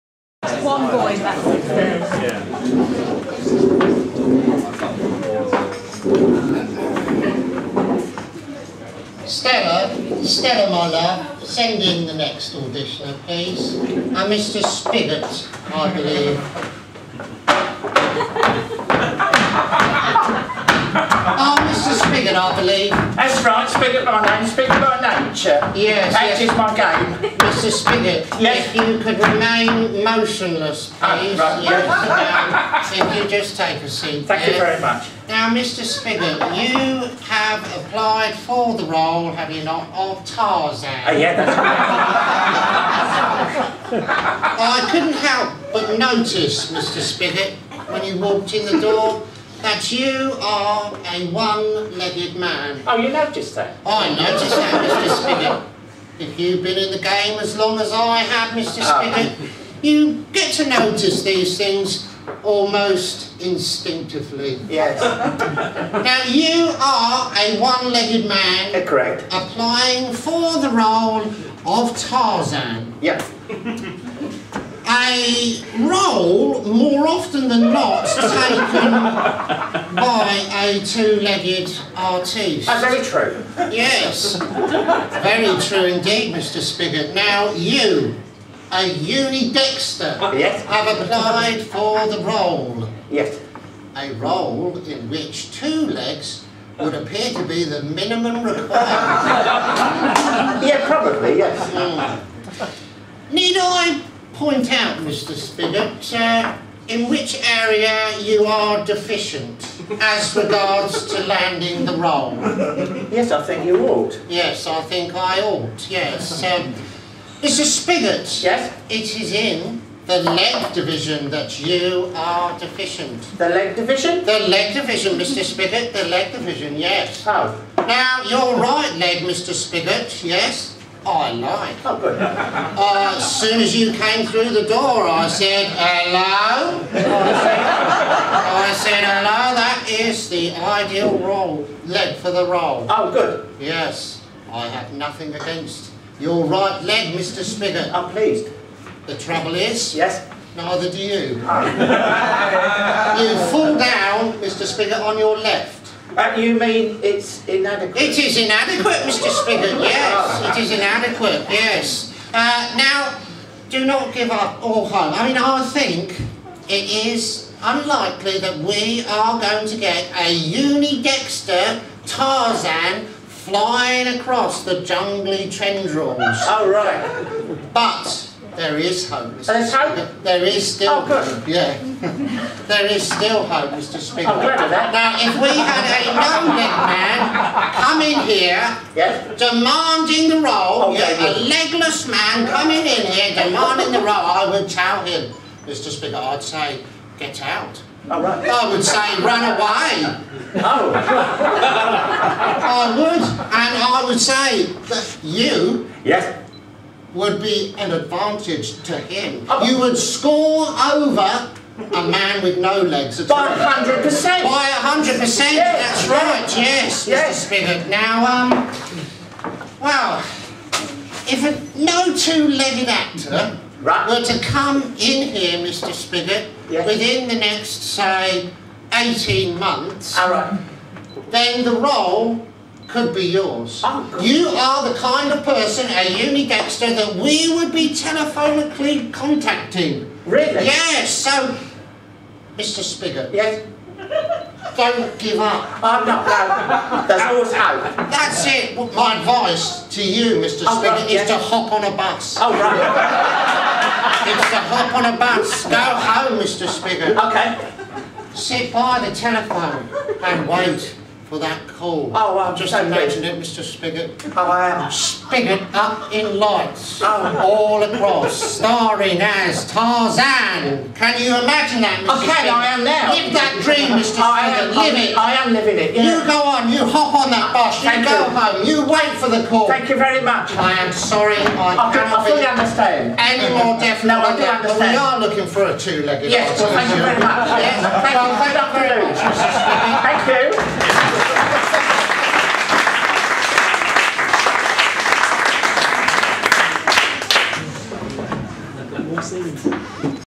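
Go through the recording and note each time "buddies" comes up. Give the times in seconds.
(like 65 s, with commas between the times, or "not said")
not said.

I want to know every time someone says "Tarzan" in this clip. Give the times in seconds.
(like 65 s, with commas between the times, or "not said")
40 s, 71 s, 172 s, 269 s.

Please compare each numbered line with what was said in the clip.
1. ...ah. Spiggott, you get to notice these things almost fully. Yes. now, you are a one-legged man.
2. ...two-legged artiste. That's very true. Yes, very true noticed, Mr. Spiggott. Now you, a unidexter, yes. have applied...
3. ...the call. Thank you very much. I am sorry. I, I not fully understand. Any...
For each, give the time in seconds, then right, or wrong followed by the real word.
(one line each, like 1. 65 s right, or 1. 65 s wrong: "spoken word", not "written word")
1. 58 s wrong: "instinctively", not "fully"
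2. 80 s wrong: "indeed", not "noticed"
3. 279 s right.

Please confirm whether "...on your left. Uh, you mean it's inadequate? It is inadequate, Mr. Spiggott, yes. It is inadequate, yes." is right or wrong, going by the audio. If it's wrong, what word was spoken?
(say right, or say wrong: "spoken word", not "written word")
right.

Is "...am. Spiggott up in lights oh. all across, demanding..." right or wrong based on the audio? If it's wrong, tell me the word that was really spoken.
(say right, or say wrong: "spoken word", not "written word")
wrong: "starring", not "demanding".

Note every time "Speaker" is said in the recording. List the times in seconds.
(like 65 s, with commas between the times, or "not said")
183 s, 195 s.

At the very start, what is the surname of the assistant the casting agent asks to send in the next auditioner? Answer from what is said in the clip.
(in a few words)
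Moller.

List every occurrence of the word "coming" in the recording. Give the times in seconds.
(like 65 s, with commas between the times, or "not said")
187 s, 192 s.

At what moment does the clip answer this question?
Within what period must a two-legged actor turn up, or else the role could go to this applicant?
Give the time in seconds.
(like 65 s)
228 s.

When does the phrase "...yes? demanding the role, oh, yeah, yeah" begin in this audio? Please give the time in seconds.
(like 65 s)
188 s.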